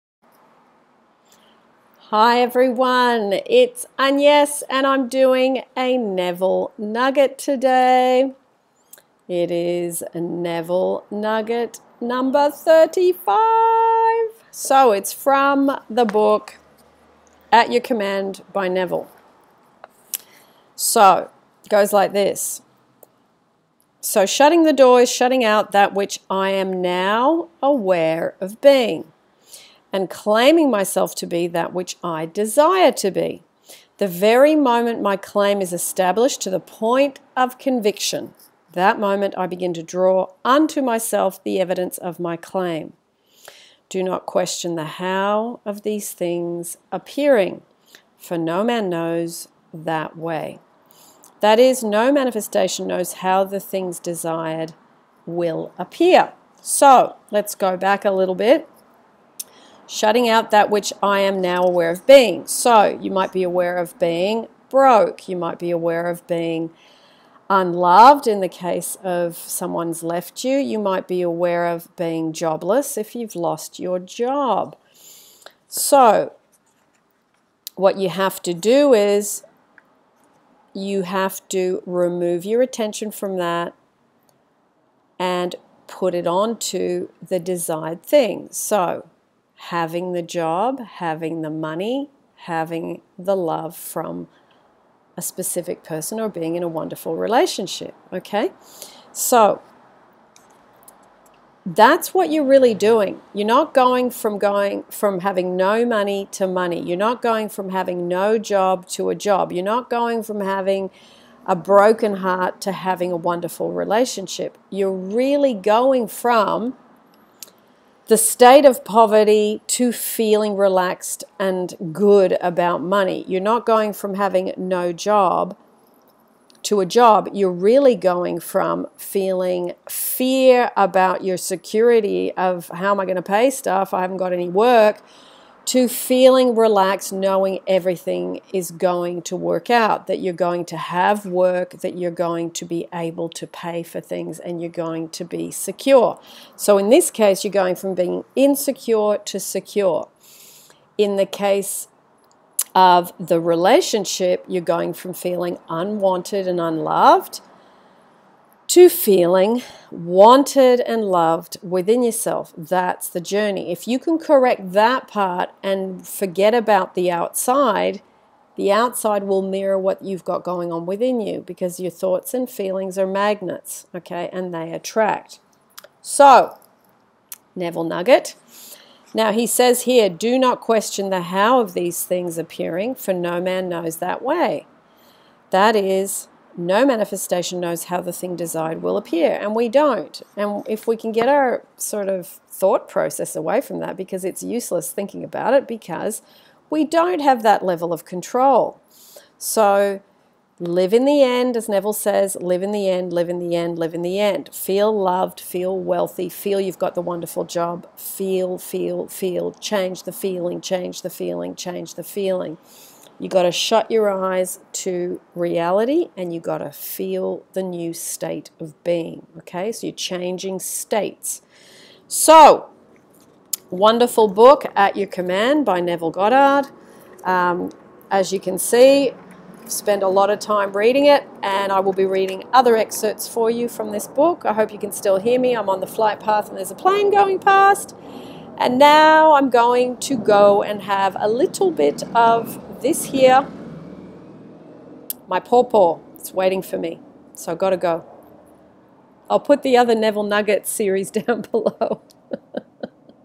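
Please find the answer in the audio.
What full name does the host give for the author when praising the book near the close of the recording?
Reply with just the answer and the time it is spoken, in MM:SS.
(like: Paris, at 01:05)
Neville Goddard, at 03:45.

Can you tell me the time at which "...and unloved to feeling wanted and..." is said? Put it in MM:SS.
02:36.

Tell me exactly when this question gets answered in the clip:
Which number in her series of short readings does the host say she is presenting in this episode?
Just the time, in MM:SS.
00:12.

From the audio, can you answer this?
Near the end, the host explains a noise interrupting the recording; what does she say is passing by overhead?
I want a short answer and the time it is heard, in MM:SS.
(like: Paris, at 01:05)
A plane, at 03:56.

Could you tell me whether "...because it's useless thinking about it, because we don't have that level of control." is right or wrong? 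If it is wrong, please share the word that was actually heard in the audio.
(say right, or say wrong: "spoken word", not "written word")
right.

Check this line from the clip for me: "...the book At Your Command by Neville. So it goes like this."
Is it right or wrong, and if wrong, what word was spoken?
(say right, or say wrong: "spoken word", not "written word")
right.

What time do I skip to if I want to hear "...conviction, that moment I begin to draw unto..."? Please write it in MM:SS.
00:37.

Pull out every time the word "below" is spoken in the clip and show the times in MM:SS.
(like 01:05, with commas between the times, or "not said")
04:11.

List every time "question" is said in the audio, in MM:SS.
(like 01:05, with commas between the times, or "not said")
00:44, 03:00.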